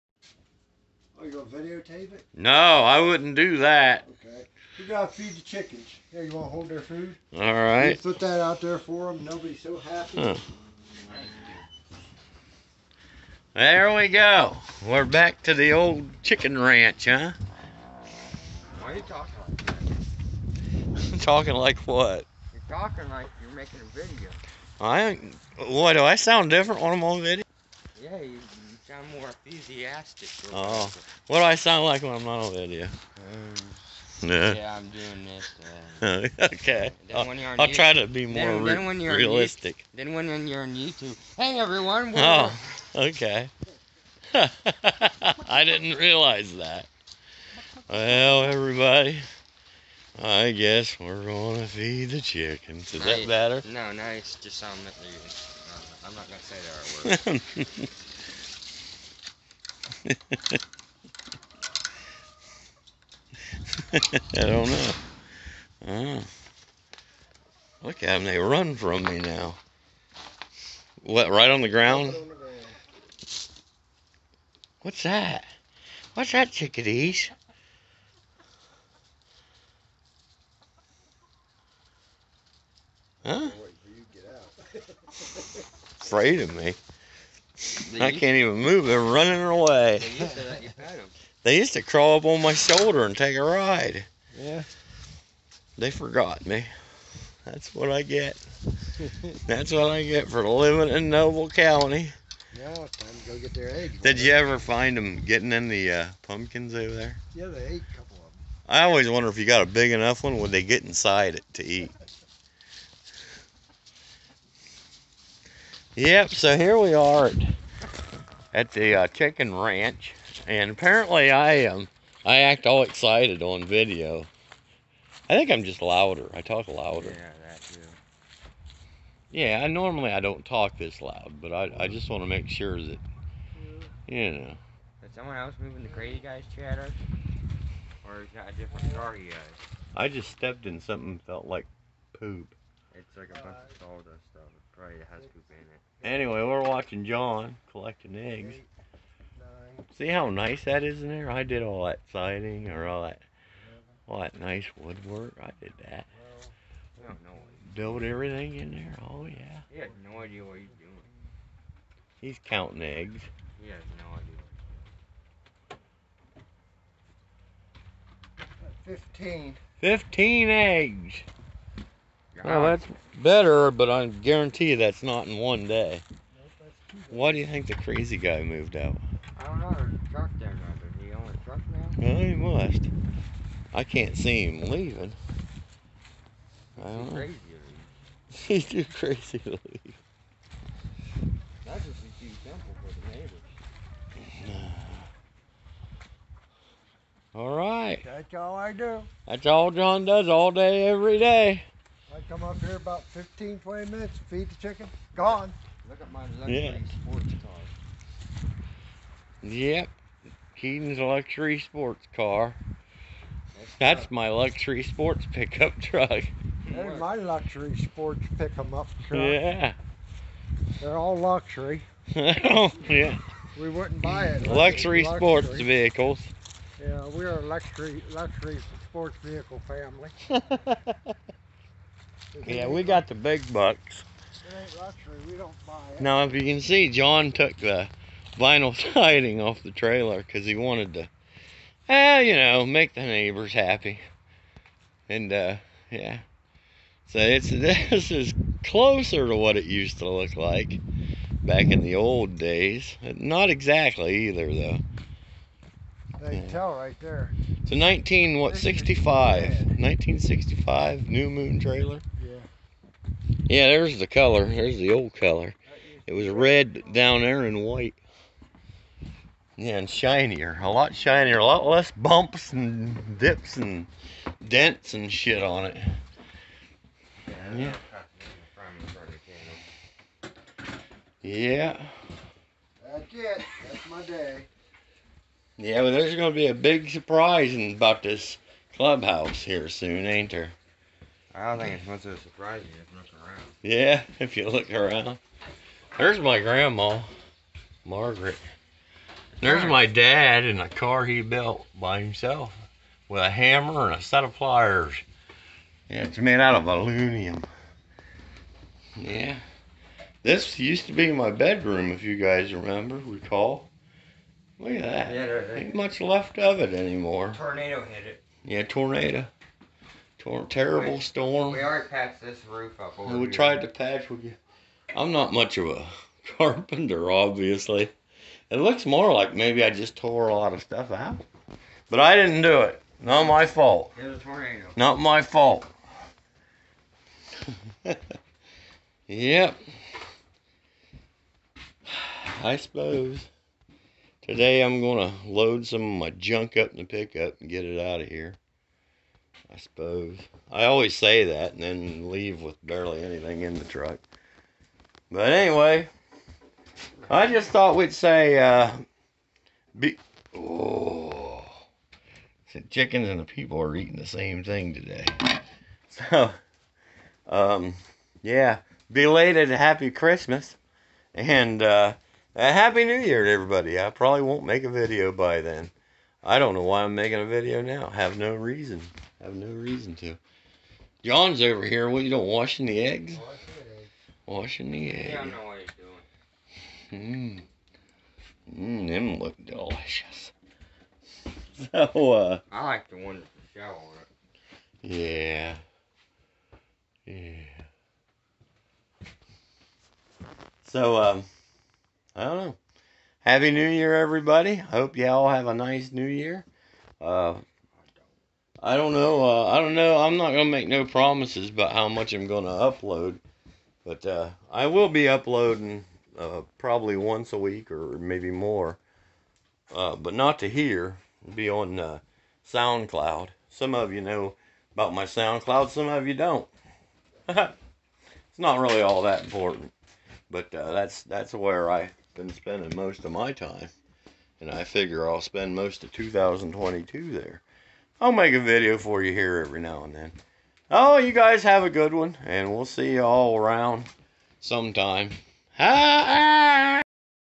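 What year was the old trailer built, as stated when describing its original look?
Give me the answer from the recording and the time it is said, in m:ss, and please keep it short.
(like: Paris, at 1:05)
1965, at 4:19.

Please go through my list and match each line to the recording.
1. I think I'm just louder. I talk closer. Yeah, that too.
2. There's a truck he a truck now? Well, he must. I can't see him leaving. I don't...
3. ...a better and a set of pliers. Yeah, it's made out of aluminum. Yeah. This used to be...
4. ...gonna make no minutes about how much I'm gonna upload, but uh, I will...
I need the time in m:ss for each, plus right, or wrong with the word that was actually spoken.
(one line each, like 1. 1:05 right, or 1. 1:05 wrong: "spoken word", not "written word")
1. 2:05 wrong: "louder", not "closer"
2. 2:59 right
3. 5:03 wrong: "hammer", not "better"
4. 6:50 wrong: "promises", not "minutes".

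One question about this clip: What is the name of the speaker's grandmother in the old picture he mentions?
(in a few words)
Margaret.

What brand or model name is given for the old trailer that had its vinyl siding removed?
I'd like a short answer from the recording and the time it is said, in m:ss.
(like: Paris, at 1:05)
New Moon, at 4:21.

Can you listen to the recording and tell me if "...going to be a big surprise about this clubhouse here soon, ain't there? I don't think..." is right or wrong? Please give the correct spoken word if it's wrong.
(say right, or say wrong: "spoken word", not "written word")
right.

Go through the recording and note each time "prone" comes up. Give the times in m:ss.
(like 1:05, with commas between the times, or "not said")
not said.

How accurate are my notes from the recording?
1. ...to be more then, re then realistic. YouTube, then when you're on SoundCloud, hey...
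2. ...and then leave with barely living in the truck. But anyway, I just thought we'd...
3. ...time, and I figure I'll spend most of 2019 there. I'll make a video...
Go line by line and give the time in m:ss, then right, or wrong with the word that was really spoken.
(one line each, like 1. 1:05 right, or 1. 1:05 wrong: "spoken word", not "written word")
1. 0:37 wrong: "YouTube", not "SoundCloud"
2. 5:51 wrong: "anything", not "living"
3. 7:13 wrong: "2022", not "2019".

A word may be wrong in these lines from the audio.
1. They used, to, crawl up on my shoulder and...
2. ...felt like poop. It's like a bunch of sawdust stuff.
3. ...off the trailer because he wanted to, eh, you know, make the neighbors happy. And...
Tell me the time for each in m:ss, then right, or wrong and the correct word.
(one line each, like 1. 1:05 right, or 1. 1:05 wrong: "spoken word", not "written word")
1. 1:31 right
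2. 2:21 right
3. 3:59 right.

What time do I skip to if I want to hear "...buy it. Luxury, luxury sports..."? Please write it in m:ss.
3:44.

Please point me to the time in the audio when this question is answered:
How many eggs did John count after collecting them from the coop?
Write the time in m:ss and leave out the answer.
2:49.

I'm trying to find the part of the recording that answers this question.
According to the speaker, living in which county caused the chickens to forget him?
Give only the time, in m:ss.
1:41.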